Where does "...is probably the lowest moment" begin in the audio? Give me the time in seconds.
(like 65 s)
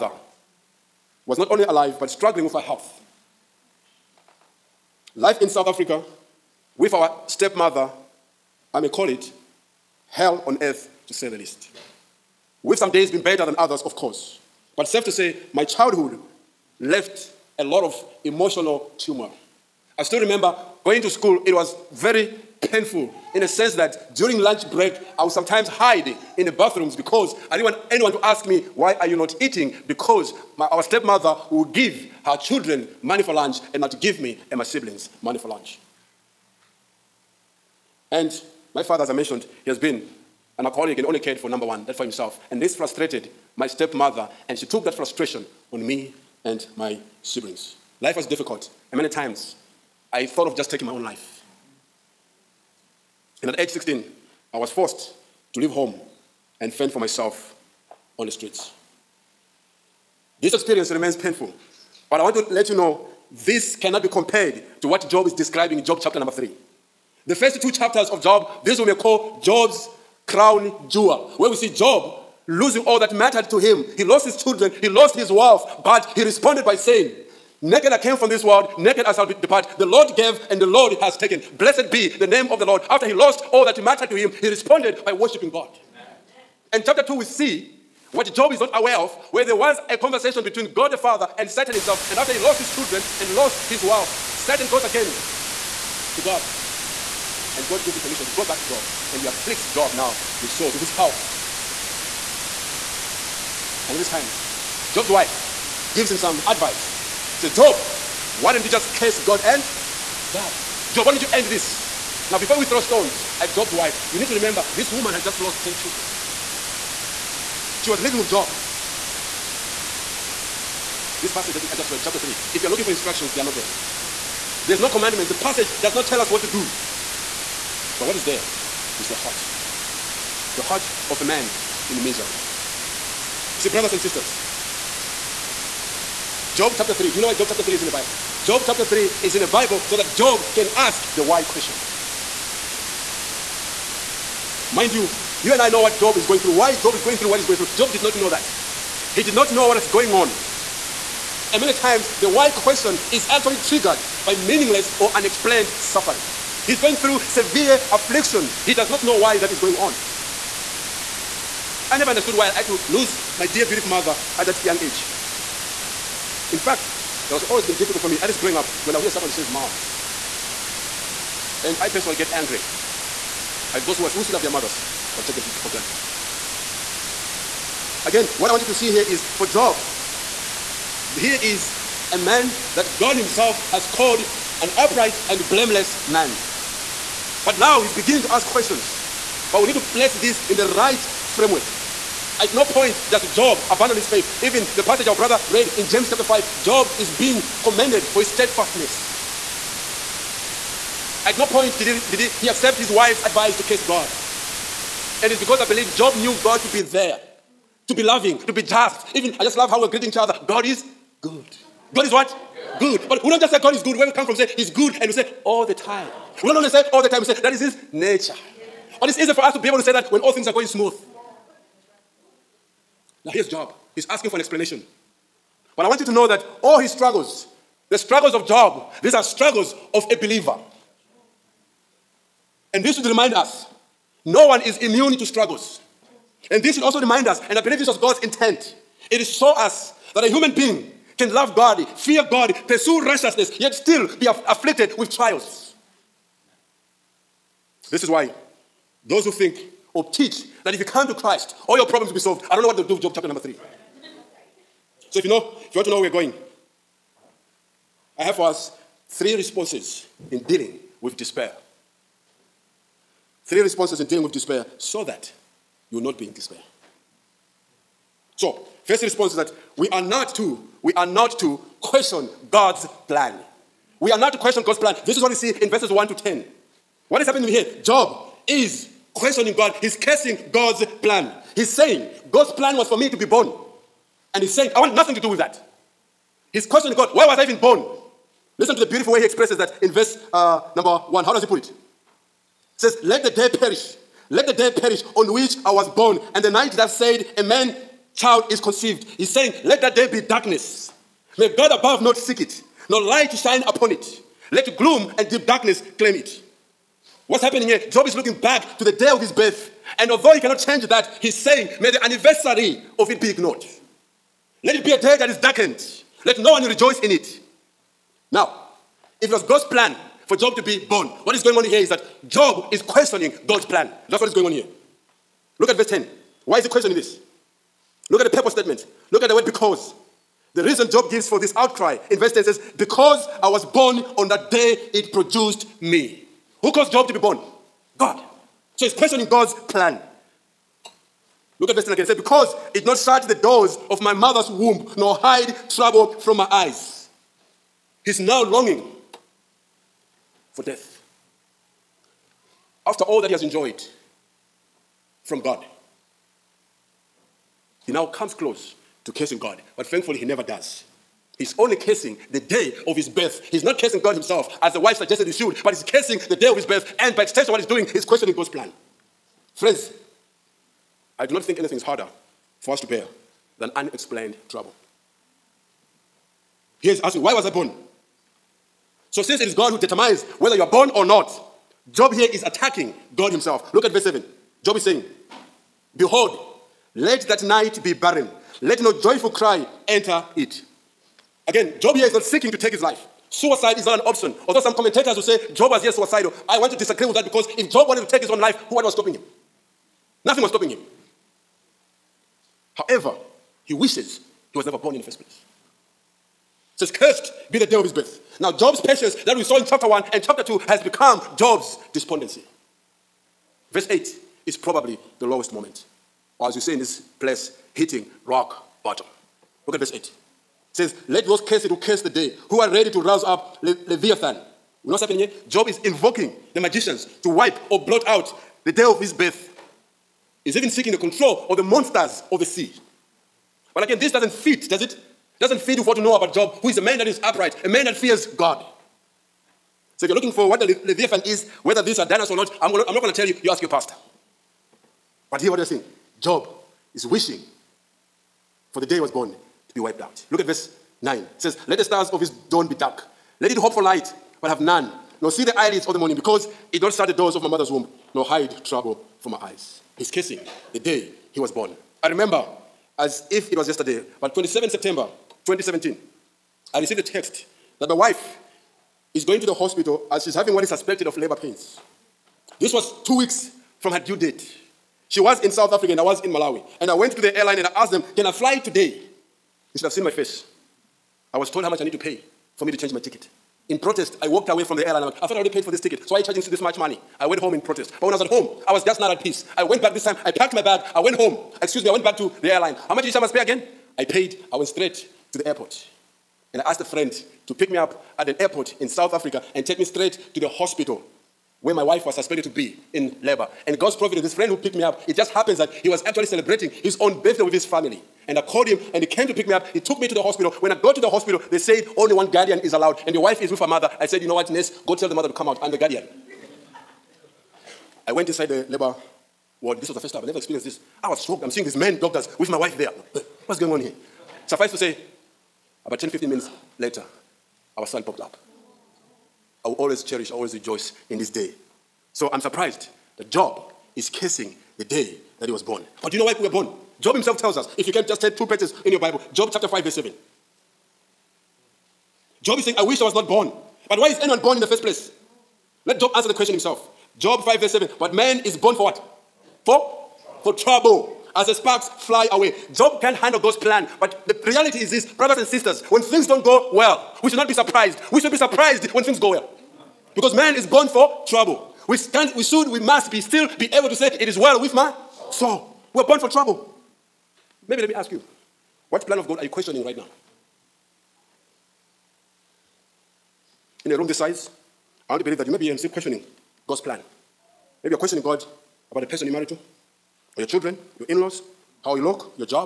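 414 s.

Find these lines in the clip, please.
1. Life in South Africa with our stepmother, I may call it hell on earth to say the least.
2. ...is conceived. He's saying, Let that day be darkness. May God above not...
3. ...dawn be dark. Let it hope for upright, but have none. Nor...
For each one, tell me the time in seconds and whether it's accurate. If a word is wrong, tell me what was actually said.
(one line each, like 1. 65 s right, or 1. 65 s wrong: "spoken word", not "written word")
1. 5 s right
2. 298 s right
3. 452 s wrong: "light", not "upright".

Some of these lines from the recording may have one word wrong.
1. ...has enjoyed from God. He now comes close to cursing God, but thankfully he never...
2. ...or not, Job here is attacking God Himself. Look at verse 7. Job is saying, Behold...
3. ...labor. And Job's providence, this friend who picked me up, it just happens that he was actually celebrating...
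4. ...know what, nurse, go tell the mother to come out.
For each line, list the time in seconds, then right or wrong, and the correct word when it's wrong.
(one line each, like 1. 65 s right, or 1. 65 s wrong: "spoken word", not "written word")
1. 353 s right
2. 380 s right
3. 503 s wrong: "God", not "Job"
4. 514 s right.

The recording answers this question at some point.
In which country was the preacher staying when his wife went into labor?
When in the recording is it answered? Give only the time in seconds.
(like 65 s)
476 s.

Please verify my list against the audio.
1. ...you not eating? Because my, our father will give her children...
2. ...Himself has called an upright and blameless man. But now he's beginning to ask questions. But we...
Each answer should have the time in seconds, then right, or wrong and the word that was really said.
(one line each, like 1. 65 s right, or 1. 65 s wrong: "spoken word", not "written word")
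1. 29 s wrong: "stepmother", not "father"
2. 183 s right.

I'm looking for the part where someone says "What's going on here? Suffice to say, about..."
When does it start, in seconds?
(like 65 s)
523 s.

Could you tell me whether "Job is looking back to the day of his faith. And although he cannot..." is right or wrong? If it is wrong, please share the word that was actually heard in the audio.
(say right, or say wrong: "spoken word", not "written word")
wrong: "birth", not "faith".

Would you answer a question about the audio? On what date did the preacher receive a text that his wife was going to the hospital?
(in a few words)
27 September 2017.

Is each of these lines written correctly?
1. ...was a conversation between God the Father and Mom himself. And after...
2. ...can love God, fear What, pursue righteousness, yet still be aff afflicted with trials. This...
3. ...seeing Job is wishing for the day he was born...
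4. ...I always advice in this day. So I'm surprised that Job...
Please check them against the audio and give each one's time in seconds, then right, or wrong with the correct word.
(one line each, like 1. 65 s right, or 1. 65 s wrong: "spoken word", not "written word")
1. 89 s wrong: "Satan", not "Mom"
2. 241 s wrong: "God", not "What"
3. 445 s right
4. 530 s wrong: "rejoice", not "advice".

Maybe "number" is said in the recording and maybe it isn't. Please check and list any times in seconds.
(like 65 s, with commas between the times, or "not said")
41 s, 66 s, 253 s, 290 s.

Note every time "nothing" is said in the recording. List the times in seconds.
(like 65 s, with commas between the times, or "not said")
284 s, 400 s.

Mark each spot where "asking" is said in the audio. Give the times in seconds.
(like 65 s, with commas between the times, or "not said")
224 s, 376 s.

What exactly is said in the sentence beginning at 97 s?
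And God gives him permission to go back to Job.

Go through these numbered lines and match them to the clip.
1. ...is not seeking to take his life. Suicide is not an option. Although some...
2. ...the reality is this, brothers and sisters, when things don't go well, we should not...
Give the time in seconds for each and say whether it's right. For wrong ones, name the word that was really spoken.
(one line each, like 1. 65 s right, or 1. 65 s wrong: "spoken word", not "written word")
1. 392 s right
2. 554 s right.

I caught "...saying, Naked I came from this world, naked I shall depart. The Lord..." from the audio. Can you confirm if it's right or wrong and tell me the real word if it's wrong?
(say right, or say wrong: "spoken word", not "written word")
right.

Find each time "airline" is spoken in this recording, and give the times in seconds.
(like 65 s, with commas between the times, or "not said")
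477 s, 484 s, 492 s.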